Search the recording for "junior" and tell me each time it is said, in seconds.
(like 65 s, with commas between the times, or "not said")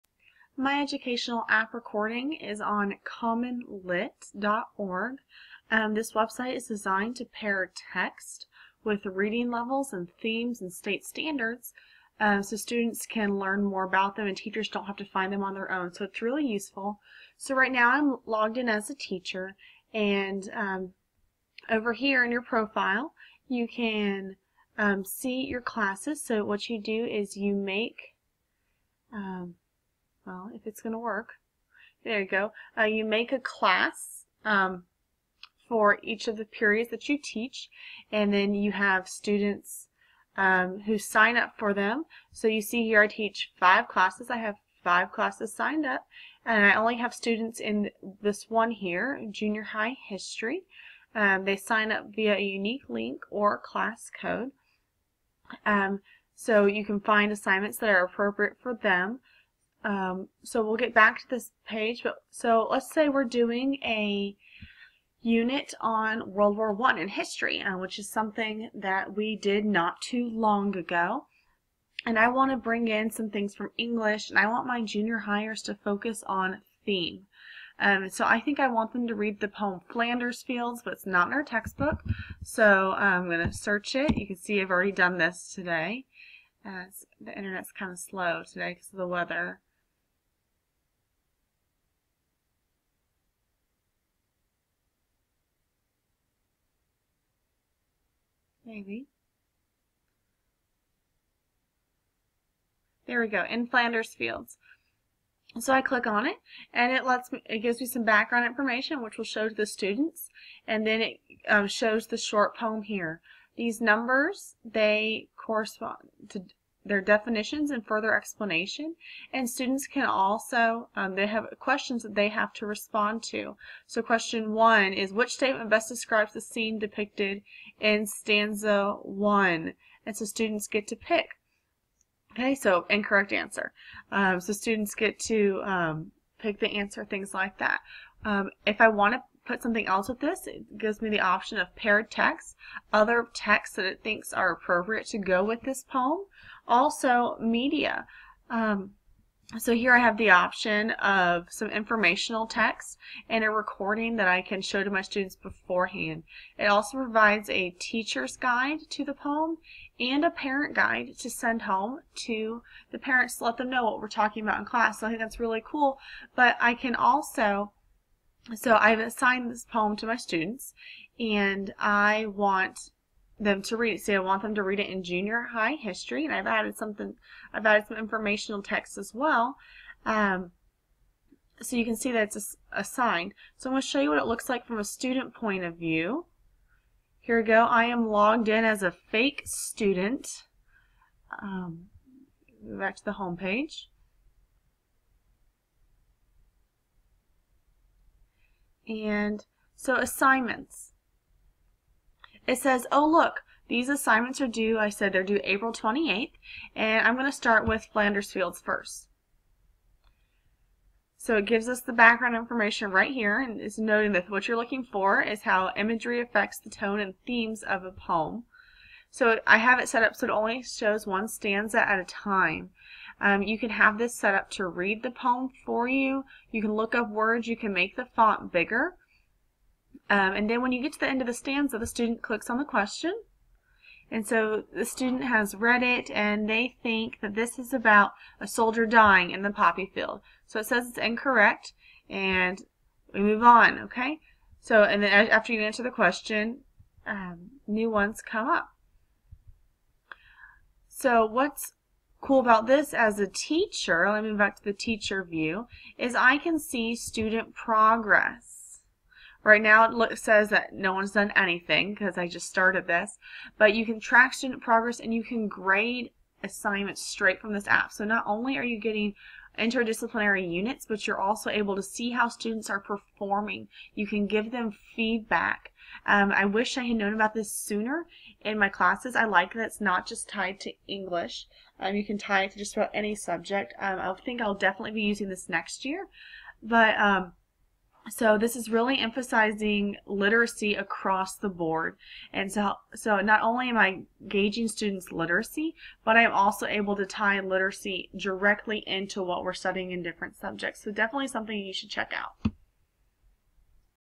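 49 s, 74 s, 175 s.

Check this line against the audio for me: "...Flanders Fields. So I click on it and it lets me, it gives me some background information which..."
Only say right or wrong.
right.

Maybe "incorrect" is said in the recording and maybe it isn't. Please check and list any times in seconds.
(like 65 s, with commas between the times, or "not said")
132 s, 240 s.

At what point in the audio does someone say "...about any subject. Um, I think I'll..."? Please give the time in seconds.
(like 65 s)
282 s.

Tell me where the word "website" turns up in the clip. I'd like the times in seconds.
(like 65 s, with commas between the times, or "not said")
6 s.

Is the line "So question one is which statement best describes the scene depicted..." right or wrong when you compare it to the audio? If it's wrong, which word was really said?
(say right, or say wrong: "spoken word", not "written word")
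right.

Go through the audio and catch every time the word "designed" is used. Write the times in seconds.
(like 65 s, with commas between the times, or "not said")
6 s.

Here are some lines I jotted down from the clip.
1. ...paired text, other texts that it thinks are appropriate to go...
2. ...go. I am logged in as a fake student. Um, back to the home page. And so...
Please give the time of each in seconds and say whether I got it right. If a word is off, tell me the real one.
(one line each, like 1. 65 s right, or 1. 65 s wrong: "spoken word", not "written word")
1. 141 s right
2. 187 s right.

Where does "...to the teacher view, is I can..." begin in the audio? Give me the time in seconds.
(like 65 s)
254 s.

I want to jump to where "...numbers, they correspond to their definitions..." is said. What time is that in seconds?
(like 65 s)
113 s.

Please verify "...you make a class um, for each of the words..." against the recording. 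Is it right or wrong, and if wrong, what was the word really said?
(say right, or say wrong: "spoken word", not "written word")
wrong: "periods", not "words".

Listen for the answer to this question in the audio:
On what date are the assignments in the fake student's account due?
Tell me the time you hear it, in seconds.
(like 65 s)
205 s.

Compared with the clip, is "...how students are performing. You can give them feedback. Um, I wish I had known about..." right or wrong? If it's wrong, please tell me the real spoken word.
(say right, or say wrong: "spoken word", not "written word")
right.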